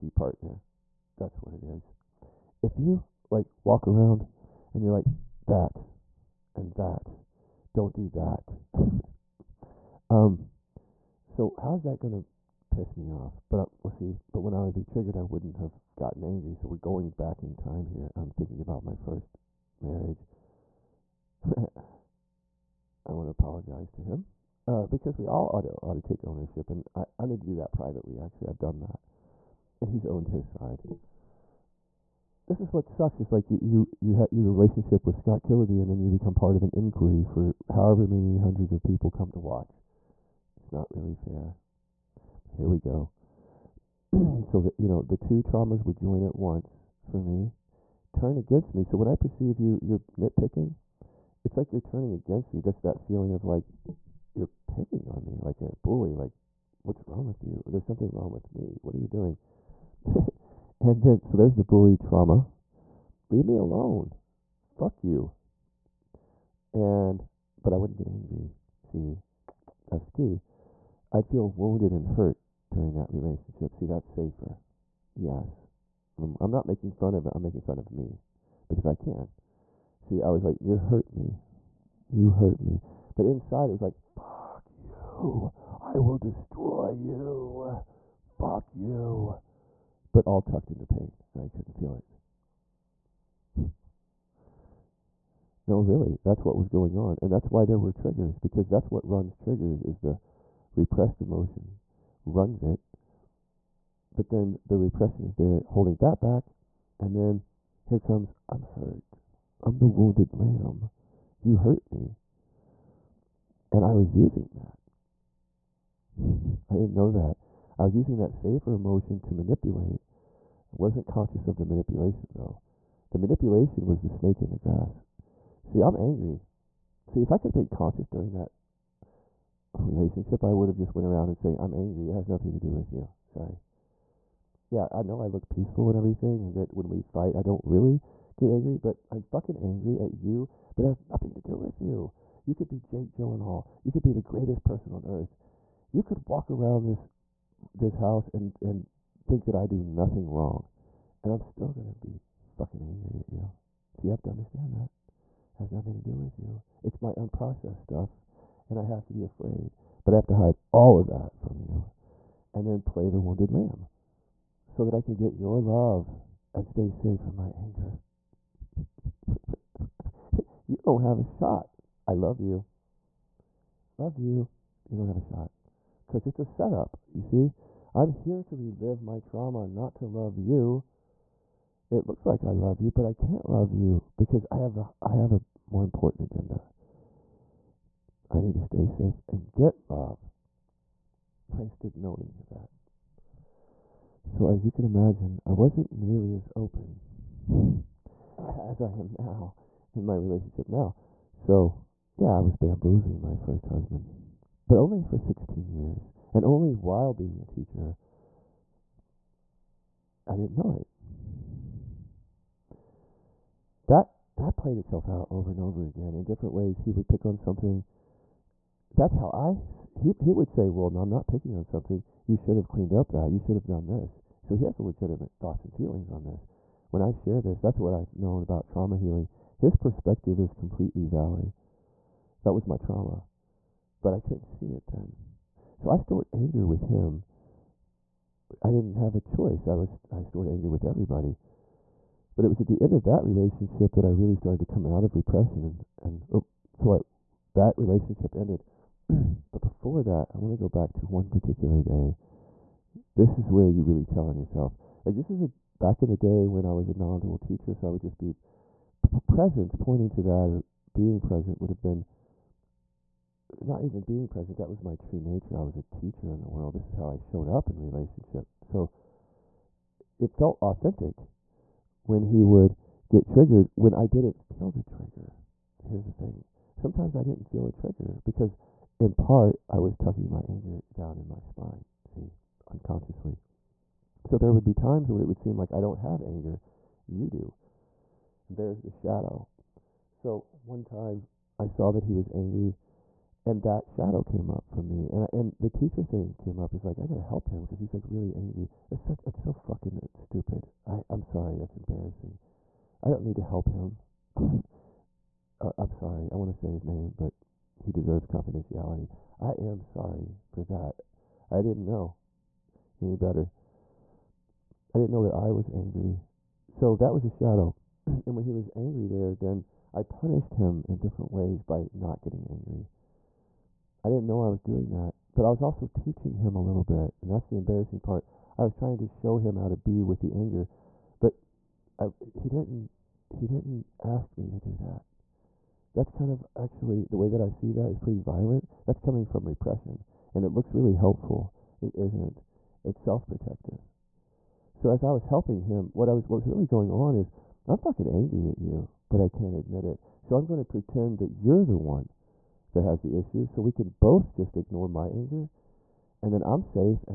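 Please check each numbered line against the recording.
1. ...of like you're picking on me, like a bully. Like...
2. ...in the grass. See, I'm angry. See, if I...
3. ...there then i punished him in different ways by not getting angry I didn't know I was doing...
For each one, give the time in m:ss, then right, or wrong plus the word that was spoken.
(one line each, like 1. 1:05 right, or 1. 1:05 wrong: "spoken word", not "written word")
1. 0:53 right
2. 2:04 right
3. 5:19 right.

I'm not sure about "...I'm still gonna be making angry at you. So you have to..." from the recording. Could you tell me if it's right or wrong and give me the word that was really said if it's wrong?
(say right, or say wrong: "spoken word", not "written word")
wrong: "fucking", not "making".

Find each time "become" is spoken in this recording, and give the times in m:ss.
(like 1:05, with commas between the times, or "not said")
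0:36.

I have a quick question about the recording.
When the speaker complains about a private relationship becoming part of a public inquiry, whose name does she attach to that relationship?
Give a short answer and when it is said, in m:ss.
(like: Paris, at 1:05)
Scott Killaby, at 0:35.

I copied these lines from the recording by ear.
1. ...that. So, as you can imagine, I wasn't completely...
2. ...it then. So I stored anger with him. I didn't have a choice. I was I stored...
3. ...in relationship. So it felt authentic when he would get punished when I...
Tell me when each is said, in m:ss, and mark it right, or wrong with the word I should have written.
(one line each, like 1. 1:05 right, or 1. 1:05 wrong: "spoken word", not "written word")
1. 3:12 wrong: "nearly", not "completely"
2. 3:54 right
3. 4:27 wrong: "triggered", not "punished".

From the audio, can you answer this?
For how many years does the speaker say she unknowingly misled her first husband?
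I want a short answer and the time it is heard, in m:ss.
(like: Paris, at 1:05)
16, at 3:25.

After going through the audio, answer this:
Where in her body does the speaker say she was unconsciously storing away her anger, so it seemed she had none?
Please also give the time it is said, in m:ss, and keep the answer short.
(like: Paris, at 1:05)
spine, at 4:41.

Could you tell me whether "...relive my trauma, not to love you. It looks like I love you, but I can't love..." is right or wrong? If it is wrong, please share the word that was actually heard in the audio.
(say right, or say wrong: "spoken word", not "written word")
right.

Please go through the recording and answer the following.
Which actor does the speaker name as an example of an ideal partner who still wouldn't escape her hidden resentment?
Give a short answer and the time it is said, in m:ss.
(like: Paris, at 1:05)
Jake Gyllenhaal, at 2:22.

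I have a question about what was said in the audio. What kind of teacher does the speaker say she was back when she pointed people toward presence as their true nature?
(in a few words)
non-dual teacher.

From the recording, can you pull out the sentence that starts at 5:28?
I was trying to show him how to be with the anger, but I, he didn't.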